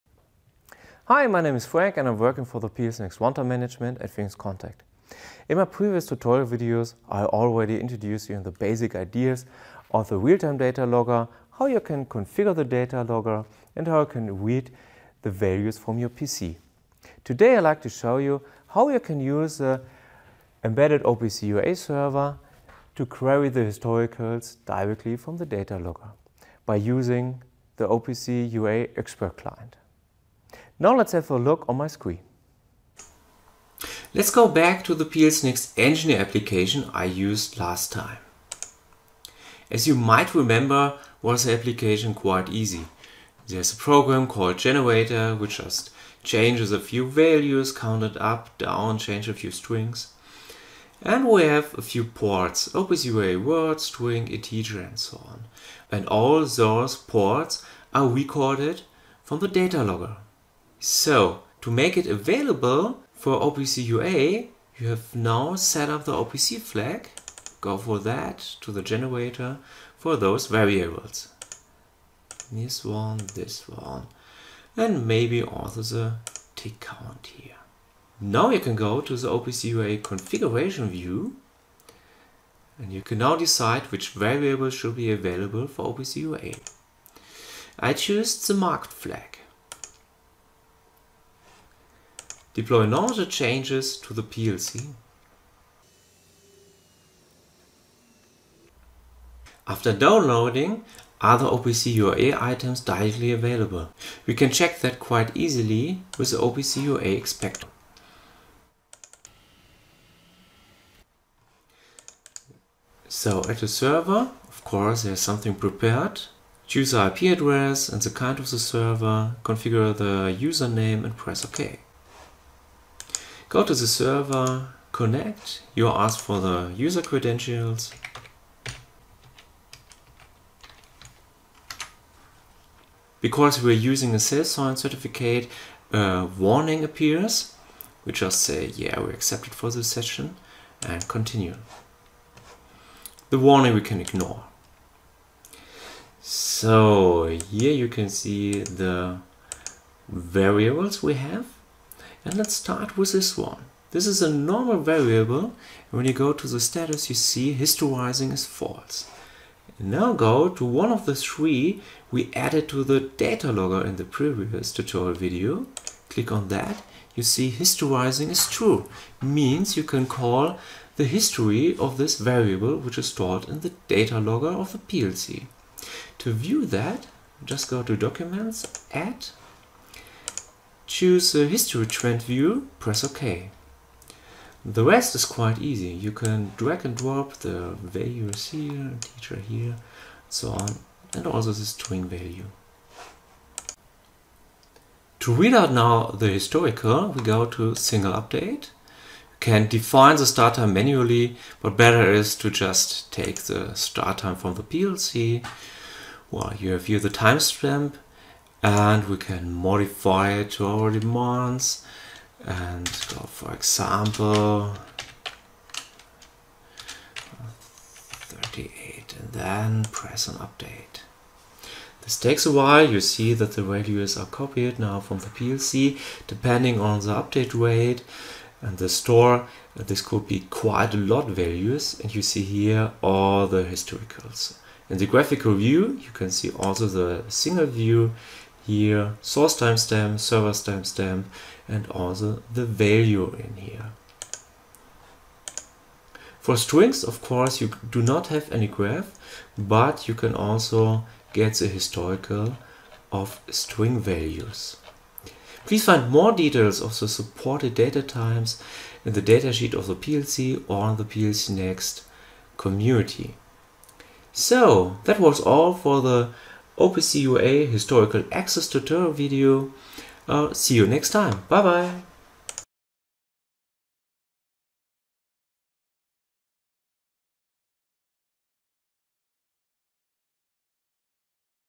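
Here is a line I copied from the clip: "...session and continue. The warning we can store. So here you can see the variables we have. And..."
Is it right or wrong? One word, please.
wrong.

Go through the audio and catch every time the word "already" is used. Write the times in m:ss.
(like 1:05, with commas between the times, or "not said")
0:07.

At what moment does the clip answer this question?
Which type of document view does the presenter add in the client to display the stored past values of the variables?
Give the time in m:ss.
3:01.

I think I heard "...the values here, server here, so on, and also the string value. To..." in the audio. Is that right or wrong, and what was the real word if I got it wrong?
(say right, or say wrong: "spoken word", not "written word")
wrong: "teacher", not "server".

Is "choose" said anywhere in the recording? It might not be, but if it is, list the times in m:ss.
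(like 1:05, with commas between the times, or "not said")
1:27, 1:56, 3:01.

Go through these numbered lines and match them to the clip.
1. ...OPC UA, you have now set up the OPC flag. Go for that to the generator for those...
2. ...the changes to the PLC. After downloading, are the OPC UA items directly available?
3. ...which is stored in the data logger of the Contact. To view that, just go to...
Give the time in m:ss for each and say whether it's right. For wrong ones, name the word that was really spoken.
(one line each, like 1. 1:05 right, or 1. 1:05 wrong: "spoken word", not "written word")
1. 1:03 right
2. 1:32 right
3. 2:52 wrong: "PLC", not "Contact".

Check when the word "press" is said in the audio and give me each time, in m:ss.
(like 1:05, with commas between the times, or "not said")
2:01, 3:02, 3:39.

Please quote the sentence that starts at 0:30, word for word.
Now let's have a look on my screen.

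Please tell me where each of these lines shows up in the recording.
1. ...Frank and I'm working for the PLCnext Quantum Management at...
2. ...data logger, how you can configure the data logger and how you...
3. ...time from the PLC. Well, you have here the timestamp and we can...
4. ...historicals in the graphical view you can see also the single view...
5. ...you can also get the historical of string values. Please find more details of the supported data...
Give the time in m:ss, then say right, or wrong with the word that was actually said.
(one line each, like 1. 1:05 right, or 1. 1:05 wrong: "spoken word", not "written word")
1. 0:01 right
2. 0:10 right
3. 3:24 right
4. 3:53 right
5. 4:10 right.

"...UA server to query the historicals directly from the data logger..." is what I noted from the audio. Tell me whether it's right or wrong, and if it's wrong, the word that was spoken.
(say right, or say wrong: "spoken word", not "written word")
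right.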